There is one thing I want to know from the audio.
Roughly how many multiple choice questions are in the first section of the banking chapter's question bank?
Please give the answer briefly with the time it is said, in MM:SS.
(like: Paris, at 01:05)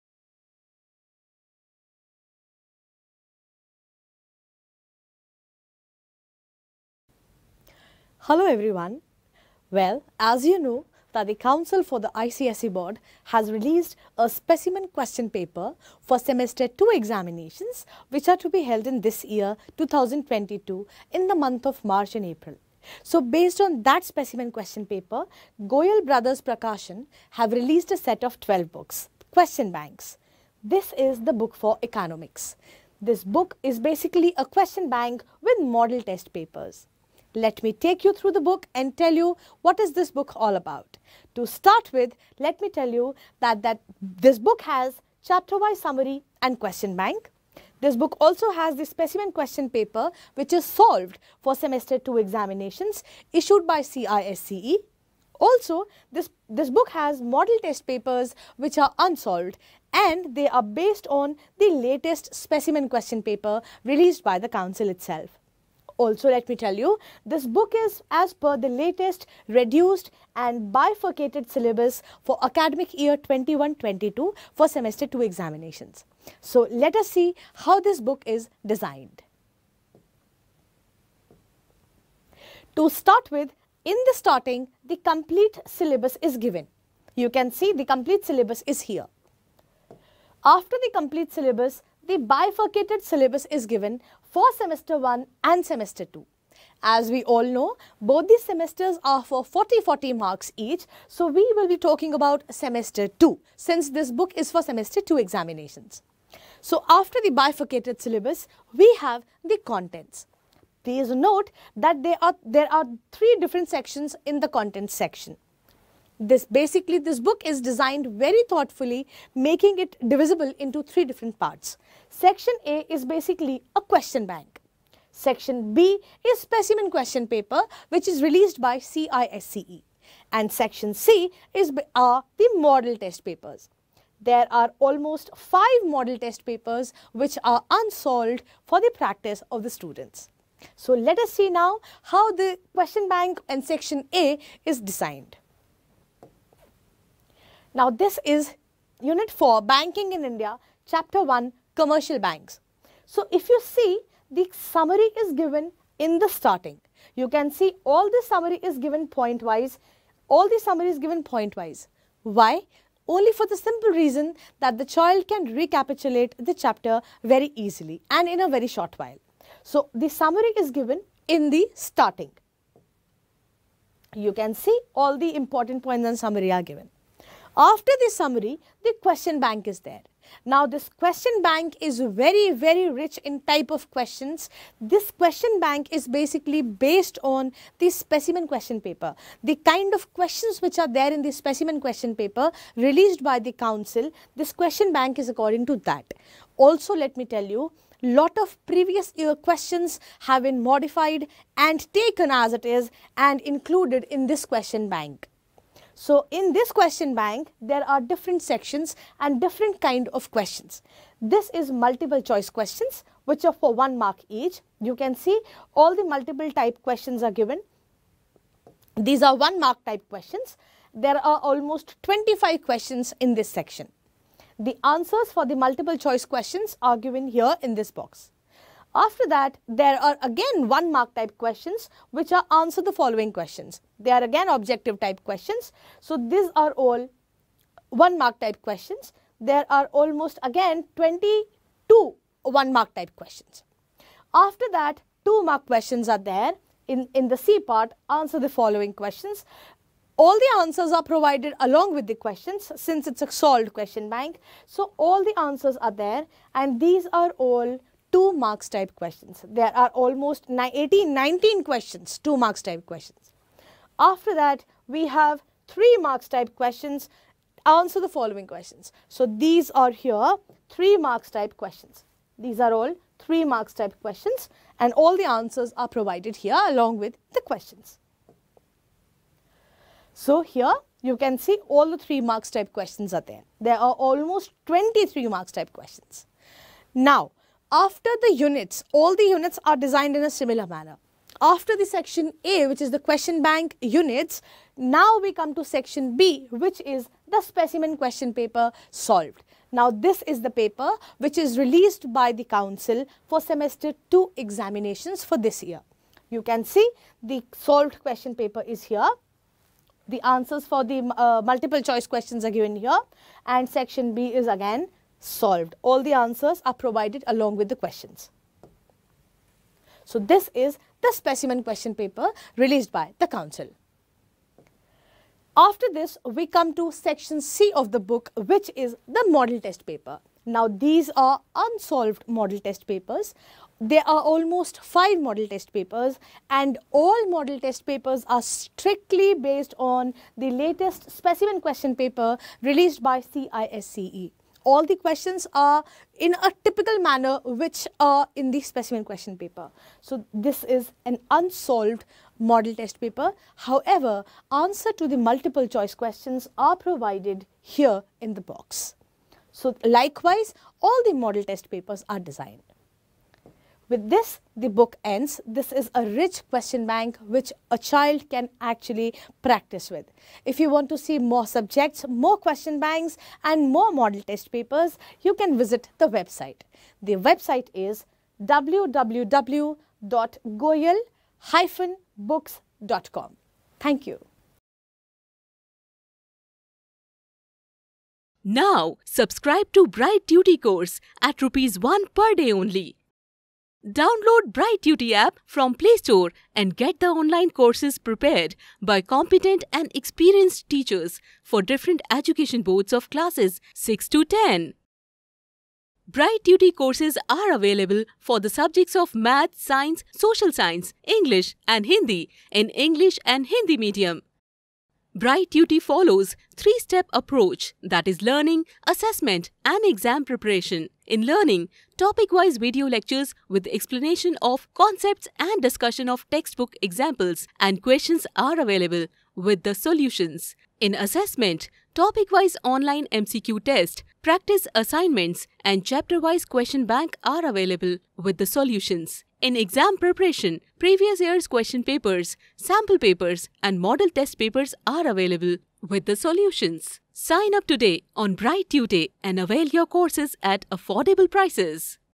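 25, at 03:42.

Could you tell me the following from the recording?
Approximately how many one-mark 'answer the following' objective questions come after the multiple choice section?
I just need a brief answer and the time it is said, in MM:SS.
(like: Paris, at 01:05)
22, at 04:00.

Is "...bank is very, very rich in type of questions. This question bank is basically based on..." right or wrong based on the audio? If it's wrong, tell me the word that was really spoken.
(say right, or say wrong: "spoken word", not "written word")
right.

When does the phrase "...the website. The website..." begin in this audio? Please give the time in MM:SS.
06:15.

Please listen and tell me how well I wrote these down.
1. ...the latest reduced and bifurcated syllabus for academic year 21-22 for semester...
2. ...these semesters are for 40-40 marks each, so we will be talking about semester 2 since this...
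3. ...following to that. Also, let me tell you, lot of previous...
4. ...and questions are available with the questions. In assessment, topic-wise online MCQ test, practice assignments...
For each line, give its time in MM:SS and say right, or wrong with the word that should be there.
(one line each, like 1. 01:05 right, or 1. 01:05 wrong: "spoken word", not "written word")
1. 01:08 right
2. 01:38 right
3. 03:15 wrong: "according", not "following"
4. 07:07 wrong: "solutions", not "questions".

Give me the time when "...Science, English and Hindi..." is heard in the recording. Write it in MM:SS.
06:50.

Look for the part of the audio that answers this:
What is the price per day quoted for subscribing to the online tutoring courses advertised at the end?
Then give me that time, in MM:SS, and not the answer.
06:31.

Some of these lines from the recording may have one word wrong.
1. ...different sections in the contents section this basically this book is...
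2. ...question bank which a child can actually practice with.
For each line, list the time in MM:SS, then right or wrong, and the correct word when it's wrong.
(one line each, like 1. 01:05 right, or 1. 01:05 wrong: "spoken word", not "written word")
1. 01:53 right
2. 06:06 right.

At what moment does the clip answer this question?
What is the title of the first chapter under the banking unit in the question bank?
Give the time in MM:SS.
02:31.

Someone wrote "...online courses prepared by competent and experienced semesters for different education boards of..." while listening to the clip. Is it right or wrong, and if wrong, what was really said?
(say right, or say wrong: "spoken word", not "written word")
wrong: "teachers", not "semesters".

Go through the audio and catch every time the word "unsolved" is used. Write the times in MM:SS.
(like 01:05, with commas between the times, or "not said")
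00:58, 02:17, 05:31, 05:51.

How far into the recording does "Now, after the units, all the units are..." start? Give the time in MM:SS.
04:46.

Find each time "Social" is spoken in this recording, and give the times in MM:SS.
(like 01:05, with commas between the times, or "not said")
06:50.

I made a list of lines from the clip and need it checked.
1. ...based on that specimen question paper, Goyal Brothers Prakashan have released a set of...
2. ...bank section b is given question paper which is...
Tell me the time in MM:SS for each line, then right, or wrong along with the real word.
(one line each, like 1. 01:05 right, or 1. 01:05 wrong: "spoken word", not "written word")
1. 00:23 right
2. 02:04 wrong: "specimen", not "given".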